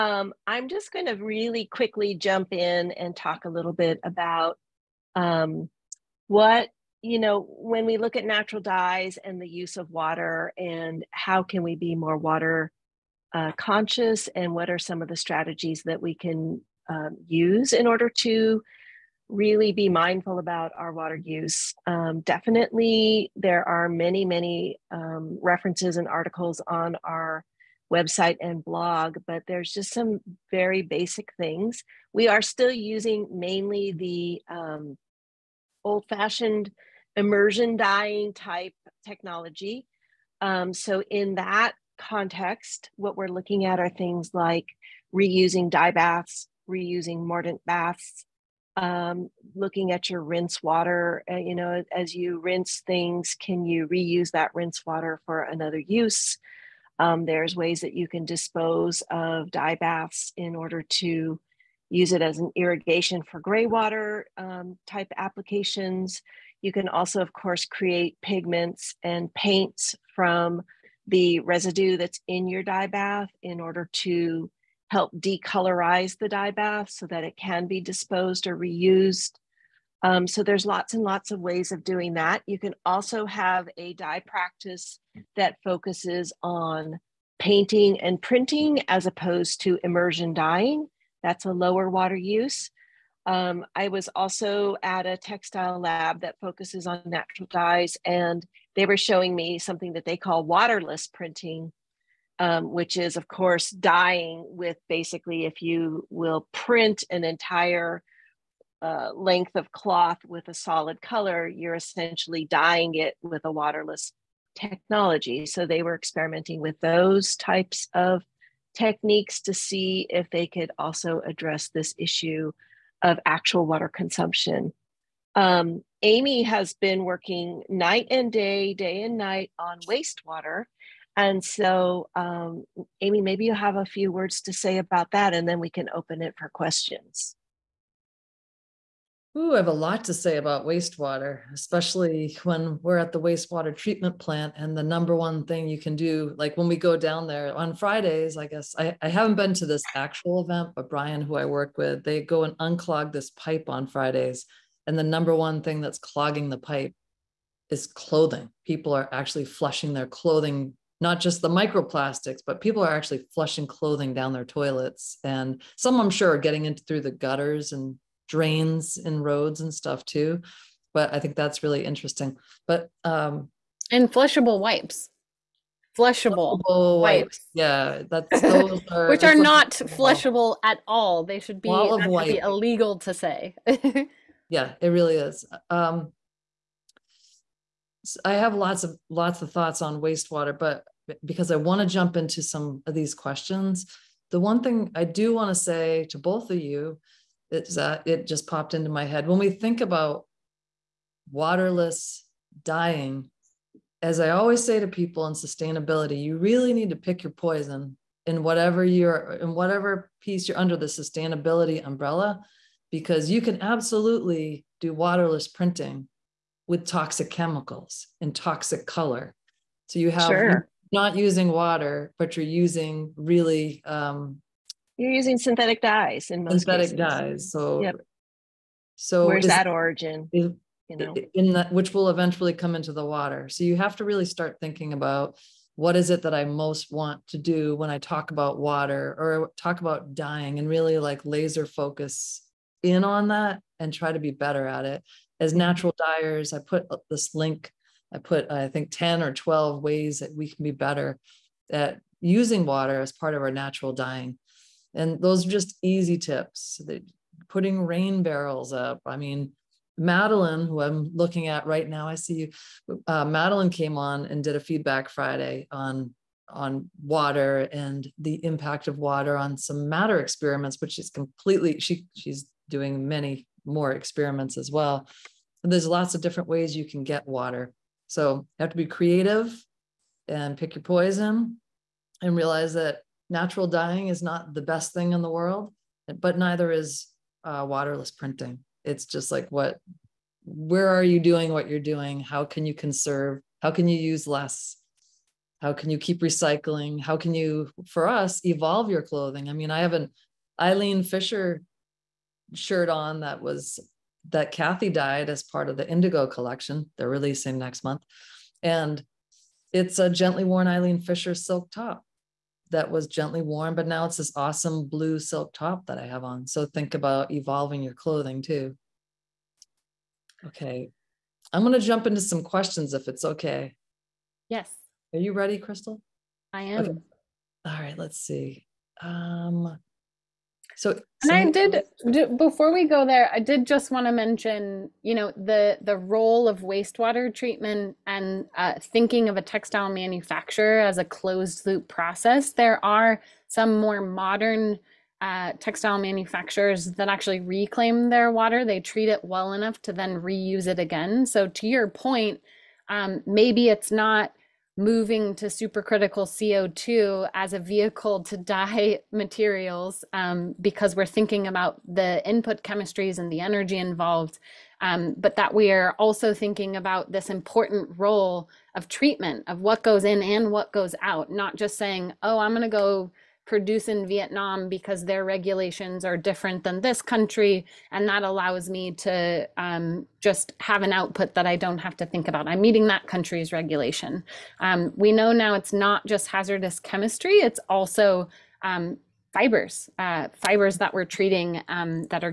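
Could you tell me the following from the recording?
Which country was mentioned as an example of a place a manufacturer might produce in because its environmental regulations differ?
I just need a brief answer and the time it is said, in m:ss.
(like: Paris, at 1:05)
Vietnam, at 6:14.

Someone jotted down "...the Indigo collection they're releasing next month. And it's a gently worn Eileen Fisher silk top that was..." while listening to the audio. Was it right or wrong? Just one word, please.
right.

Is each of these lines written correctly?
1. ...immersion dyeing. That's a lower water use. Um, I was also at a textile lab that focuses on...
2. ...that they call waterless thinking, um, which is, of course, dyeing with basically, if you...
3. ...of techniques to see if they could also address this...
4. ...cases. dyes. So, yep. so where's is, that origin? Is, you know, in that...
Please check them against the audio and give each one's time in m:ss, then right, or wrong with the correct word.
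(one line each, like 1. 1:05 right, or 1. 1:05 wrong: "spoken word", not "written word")
1. 1:29 right
2. 1:39 wrong: "printing", not "thinking"
3. 1:57 right
4. 3:46 right.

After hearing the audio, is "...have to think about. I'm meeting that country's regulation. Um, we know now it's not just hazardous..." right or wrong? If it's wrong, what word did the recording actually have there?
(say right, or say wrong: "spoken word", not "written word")
right.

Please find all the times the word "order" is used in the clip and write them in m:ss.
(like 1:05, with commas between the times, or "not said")
0:17, 1:00, 1:13.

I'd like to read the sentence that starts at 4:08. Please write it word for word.
I put I think ten or twelve ways that we can be better at using water as part of our natural dyeing.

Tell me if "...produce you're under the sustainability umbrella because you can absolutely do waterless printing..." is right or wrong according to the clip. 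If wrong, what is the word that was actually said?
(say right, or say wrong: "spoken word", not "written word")
wrong: "piece", not "produce".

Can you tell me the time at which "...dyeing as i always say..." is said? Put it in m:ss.
3:22.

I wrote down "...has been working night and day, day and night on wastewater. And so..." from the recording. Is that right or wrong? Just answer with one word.
right.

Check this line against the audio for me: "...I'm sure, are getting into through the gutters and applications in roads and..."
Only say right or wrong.
wrong.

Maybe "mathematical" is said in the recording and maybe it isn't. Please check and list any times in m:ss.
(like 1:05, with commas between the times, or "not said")
not said.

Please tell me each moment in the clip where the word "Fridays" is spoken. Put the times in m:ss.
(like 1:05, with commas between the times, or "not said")
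2:27, 2:33, 4:25.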